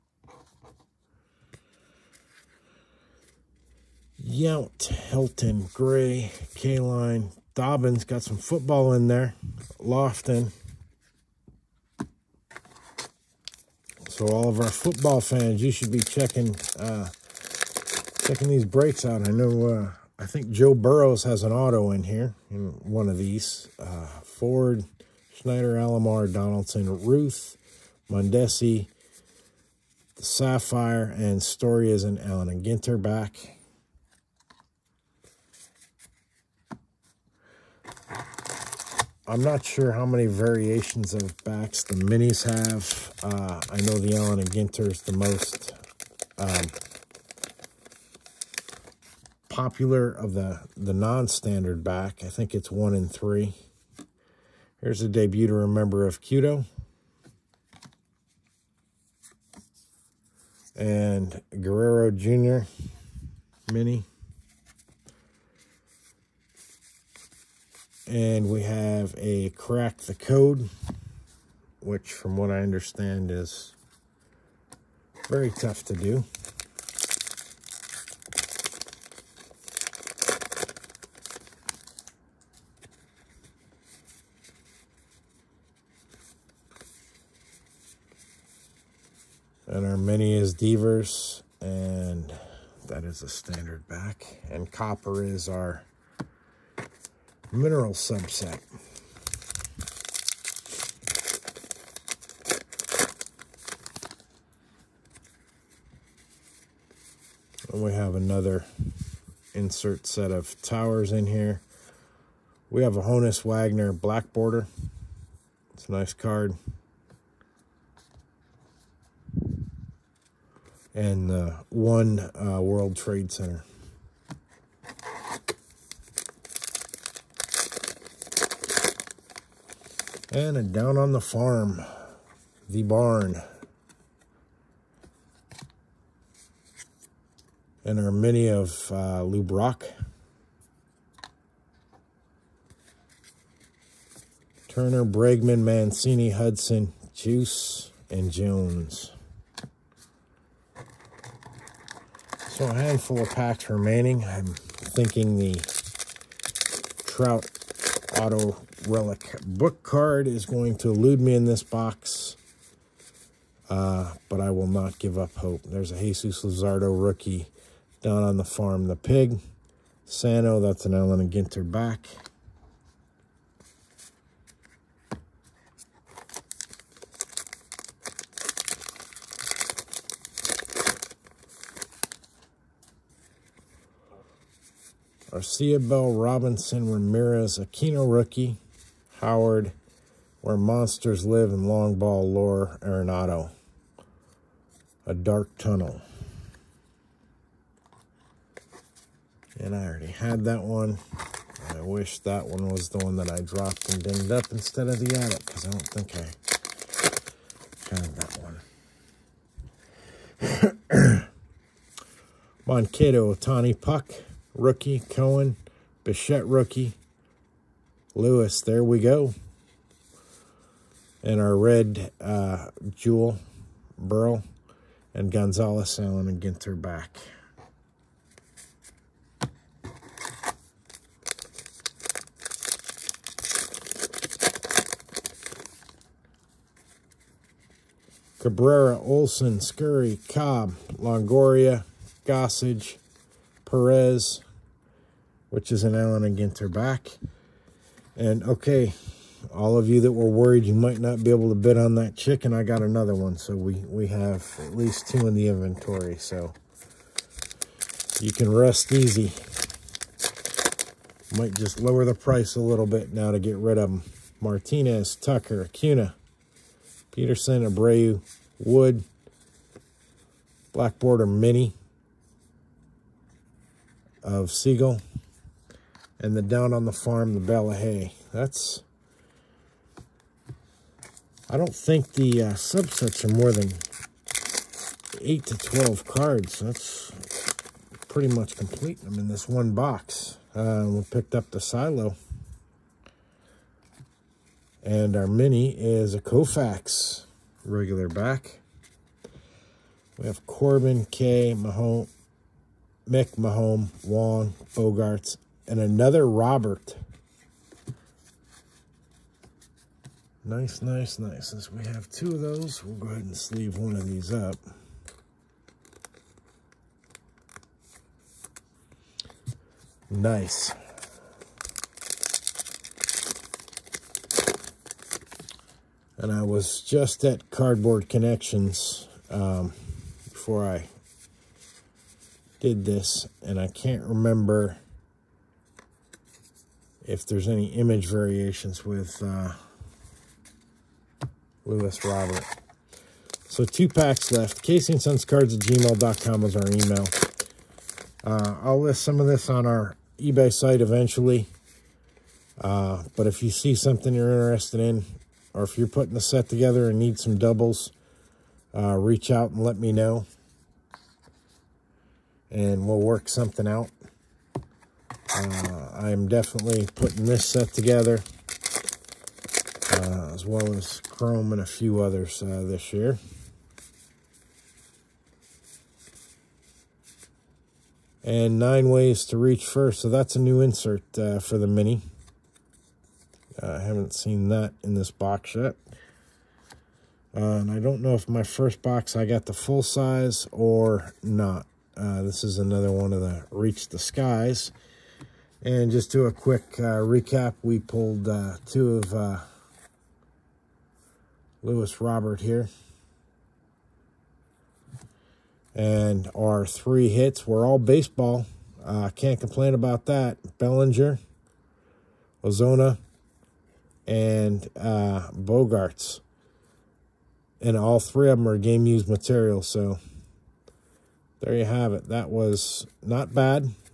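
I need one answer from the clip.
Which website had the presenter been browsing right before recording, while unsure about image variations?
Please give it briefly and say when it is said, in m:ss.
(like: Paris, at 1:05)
Cardboard Connections, at 5:27.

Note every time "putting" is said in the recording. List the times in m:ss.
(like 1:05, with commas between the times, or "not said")
5:55, 6:06.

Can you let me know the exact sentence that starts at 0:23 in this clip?
Uh, Ford, Schneider, Alomar, Donaldson, Ruth, Mondesi, Sapphire, and Story is an Allen and Ginter back.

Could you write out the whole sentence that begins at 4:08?
And okay, all of you that were worried you might not be able to bid on that chicken, I got another one.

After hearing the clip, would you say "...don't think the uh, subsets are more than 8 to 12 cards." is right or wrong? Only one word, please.
right.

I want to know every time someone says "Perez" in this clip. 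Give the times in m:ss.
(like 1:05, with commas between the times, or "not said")
4:03.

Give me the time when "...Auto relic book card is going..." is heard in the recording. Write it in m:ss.
2:38.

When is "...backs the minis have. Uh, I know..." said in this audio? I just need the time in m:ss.
0:41.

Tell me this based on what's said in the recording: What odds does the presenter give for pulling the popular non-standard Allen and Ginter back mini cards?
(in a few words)
one in three.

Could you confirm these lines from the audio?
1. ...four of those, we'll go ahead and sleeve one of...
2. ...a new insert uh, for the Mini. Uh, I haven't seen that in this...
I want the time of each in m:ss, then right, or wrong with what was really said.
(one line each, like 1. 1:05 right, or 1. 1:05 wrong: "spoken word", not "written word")
1. 5:12 wrong: "two", not "four"
2. 6:20 right.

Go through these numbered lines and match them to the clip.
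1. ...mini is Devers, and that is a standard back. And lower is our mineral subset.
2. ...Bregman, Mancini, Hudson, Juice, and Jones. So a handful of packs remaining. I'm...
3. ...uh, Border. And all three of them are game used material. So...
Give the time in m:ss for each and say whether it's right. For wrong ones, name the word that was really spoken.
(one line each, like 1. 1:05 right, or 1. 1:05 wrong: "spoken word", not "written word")
1. 1:29 wrong: "copper", not "lower"
2. 2:25 right
3. 6:54 wrong: "Bogaerts", not "Border".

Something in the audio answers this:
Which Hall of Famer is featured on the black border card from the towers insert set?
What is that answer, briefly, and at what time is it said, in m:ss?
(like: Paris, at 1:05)
Honus Wagner, at 1:53.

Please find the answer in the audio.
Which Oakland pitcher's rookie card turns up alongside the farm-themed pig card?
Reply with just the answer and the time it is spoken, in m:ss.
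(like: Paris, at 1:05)
Jesus Luzardo, at 2:45.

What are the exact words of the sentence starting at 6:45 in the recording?
And our three hits were all baseball.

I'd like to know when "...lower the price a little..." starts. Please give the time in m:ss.
4:21.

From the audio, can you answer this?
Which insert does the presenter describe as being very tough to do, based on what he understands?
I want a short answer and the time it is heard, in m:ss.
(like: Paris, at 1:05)
Crack the Code, at 1:09.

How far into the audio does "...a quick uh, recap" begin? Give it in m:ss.
6:36.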